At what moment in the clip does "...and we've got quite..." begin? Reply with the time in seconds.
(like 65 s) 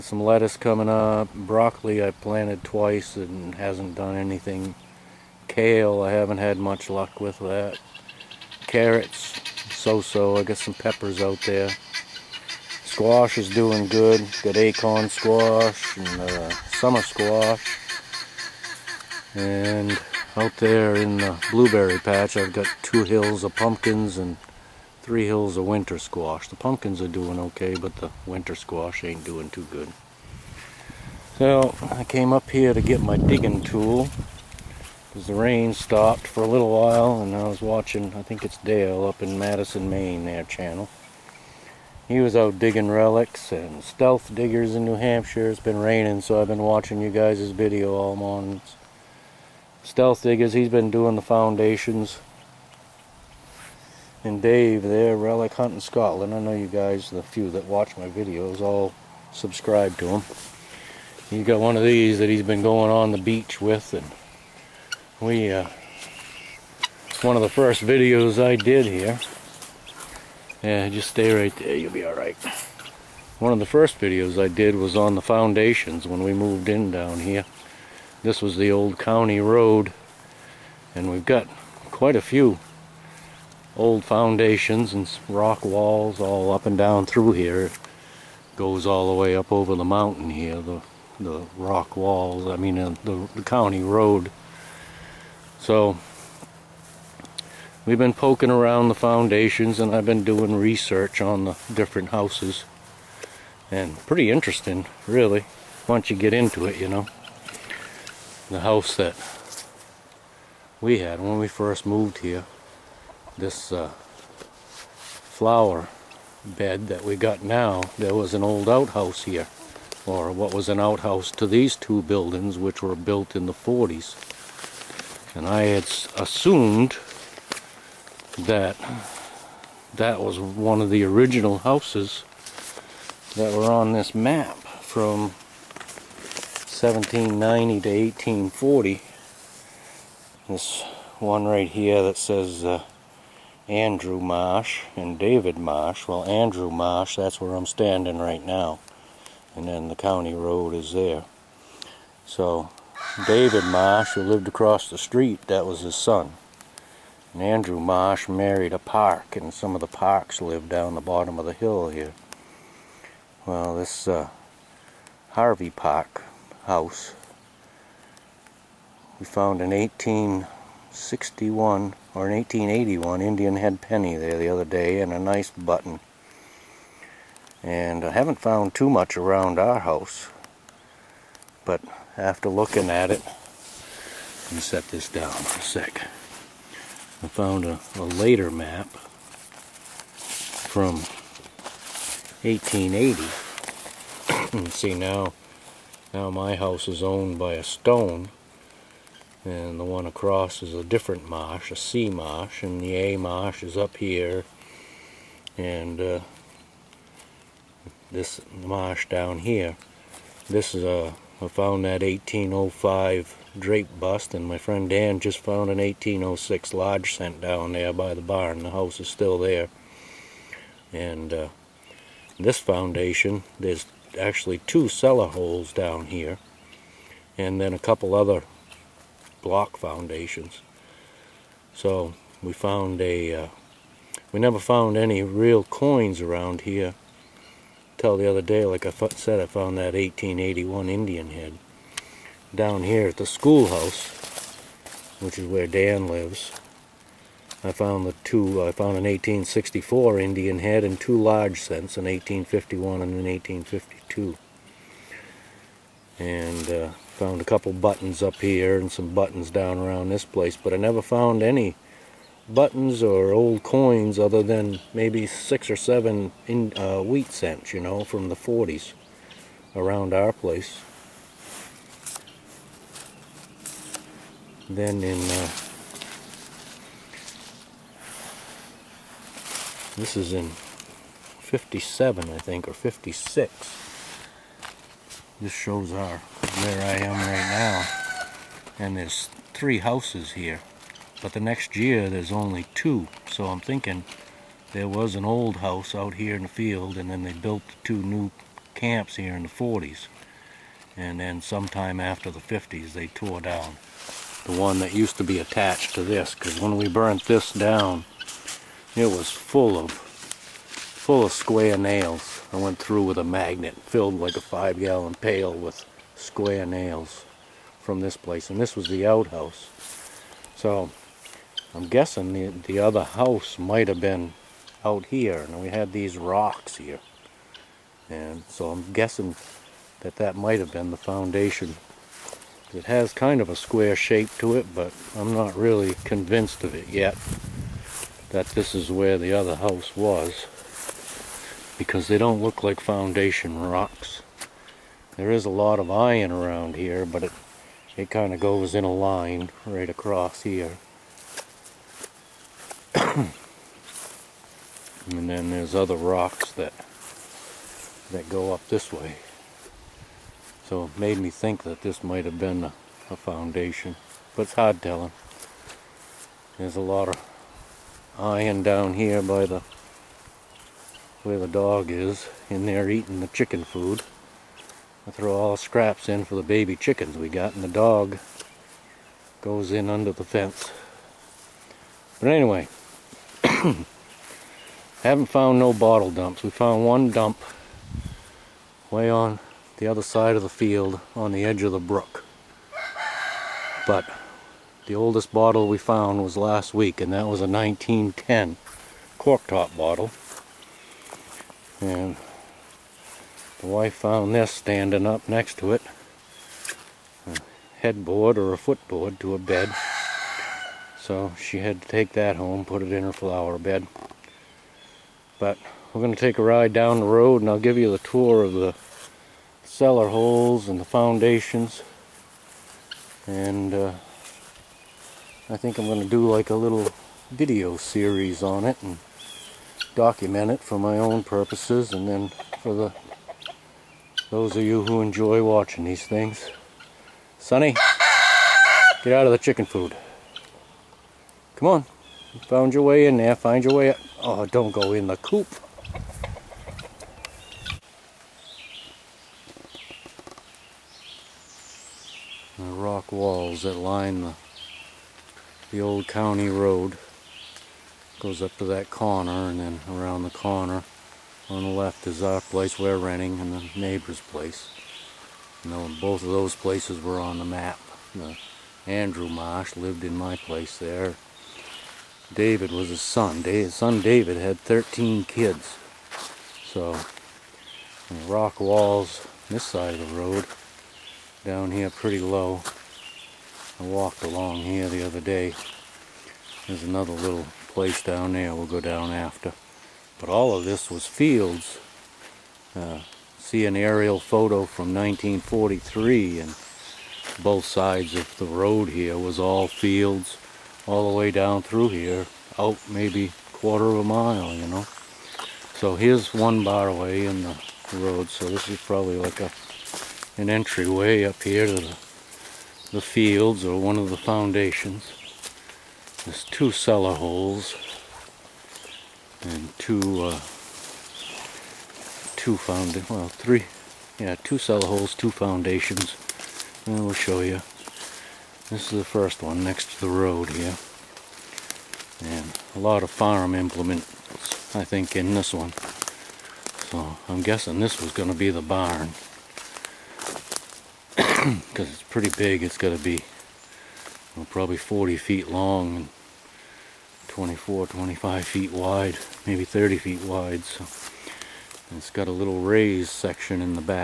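80 s.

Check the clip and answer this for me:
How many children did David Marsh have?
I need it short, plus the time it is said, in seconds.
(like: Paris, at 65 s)
13, at 474 s.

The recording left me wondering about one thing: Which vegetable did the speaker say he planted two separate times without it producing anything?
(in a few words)
Broccoli.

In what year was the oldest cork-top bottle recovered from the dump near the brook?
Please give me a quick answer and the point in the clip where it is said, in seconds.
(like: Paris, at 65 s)
1910, at 397 s.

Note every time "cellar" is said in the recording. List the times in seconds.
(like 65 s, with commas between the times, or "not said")
224 s, 419 s, 516 s, 524 s.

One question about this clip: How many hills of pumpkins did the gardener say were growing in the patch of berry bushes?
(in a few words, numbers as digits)
2.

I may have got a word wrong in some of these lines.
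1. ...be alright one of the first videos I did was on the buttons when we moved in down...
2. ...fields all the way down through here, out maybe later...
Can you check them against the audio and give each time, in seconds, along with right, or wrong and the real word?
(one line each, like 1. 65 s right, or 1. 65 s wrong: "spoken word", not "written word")
1. 71 s wrong: "foundations", not "buttons"
2. 499 s wrong: "quarter", not "later".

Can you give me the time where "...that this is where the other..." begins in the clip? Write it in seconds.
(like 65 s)
338 s.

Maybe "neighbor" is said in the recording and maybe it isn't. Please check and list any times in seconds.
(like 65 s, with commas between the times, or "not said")
463 s.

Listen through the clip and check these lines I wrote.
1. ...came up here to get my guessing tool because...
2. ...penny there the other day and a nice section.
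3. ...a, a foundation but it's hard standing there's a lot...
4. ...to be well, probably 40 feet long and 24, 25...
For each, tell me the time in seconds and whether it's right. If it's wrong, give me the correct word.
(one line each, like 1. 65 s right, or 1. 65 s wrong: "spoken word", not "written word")
1. 32 s wrong: "digging", not "guessing"
2. 173 s wrong: "button", not "section"
3. 362 s wrong: "telling", not "standing"
4. 542 s right.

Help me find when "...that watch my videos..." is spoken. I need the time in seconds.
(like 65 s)
57 s.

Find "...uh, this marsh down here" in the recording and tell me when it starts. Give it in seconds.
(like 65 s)
206 s.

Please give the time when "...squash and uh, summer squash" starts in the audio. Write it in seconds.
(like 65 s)
15 s.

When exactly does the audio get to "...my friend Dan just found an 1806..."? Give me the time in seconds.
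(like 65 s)
214 s.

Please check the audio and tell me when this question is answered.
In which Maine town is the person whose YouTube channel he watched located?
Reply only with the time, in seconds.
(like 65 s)
39 s.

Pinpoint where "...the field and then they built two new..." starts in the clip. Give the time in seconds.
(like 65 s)
296 s.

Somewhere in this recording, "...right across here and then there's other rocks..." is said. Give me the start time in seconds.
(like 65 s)
349 s.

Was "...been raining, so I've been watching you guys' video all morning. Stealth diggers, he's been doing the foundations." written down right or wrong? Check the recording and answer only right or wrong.
right.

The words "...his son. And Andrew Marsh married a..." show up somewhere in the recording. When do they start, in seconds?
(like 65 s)
155 s.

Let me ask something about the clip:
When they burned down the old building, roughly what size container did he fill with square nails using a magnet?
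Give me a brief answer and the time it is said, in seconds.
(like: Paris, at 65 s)
5 gallon pail, at 314 s.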